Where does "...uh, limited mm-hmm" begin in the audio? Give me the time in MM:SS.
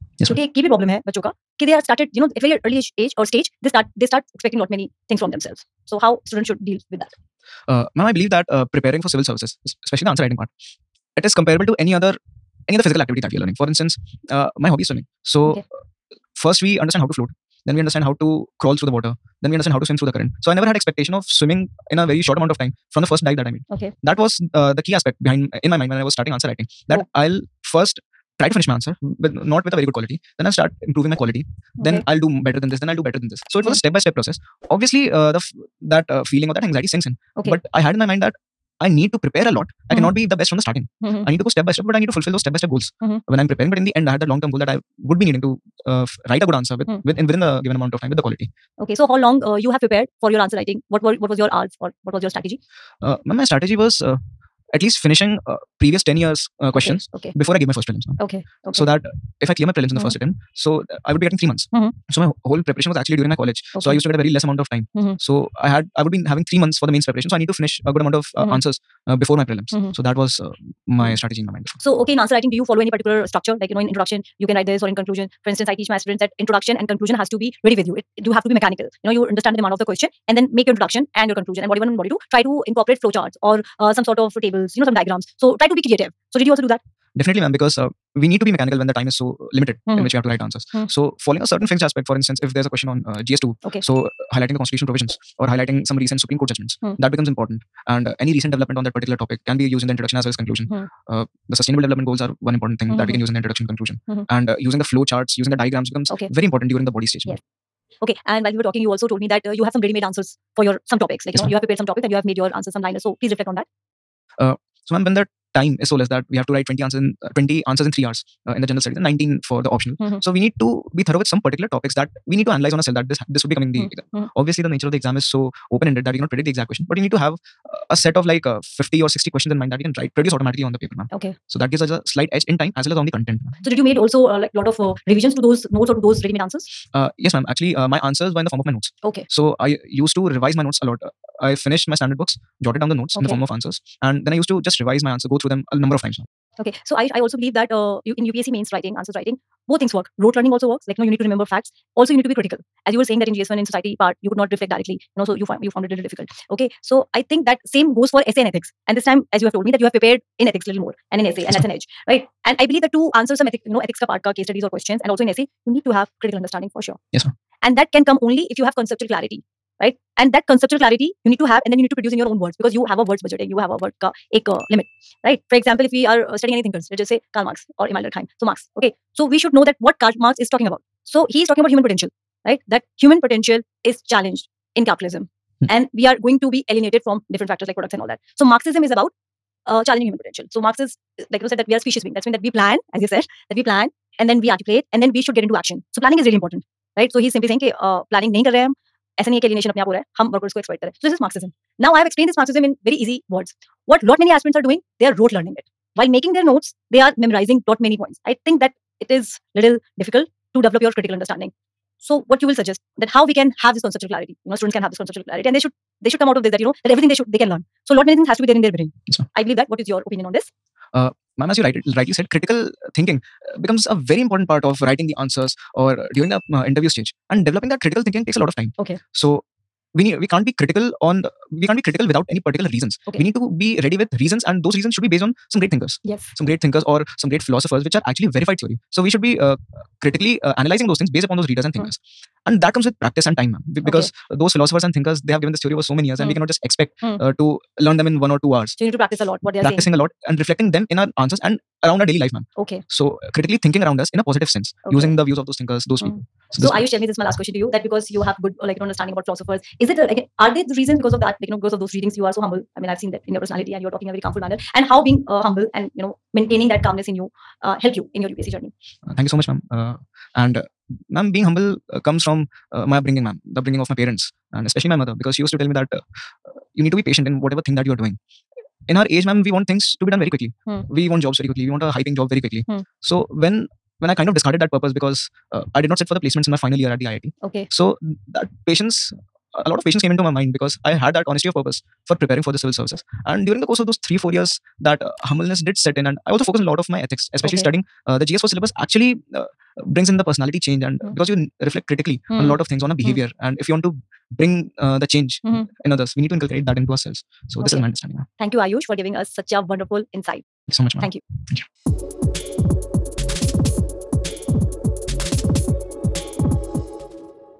01:29.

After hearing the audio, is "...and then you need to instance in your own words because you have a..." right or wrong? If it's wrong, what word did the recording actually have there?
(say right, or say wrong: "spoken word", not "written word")
wrong: "produce", not "instance".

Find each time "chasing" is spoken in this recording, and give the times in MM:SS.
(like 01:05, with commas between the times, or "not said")
not said.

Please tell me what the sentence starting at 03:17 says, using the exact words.
So he's simply saying uh, सेइंग कि planning.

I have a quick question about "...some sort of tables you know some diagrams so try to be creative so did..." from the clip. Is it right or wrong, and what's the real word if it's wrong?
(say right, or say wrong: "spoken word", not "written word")
right.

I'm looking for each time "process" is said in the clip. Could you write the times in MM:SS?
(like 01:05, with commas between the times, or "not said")
00:34.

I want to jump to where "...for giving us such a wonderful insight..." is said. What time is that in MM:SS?
05:08.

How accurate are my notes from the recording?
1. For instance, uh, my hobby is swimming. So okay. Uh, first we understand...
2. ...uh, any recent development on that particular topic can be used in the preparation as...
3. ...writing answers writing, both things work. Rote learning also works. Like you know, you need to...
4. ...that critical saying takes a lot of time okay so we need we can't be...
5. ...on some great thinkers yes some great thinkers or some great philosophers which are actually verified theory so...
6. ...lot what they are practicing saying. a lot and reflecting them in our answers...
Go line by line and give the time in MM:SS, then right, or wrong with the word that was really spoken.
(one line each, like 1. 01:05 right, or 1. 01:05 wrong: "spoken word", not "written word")
1. 00:13 right
2. 01:38 wrong: "introduction", not "preparation"
3. 02:28 right
4. 03:47 wrong: "thinking", not "saying"
5. 03:55 right
6. 04:09 right.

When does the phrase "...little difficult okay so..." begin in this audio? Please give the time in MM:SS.
02:35.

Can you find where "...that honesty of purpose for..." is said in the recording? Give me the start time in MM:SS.
04:51.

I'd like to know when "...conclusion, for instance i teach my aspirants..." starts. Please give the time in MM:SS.
01:14.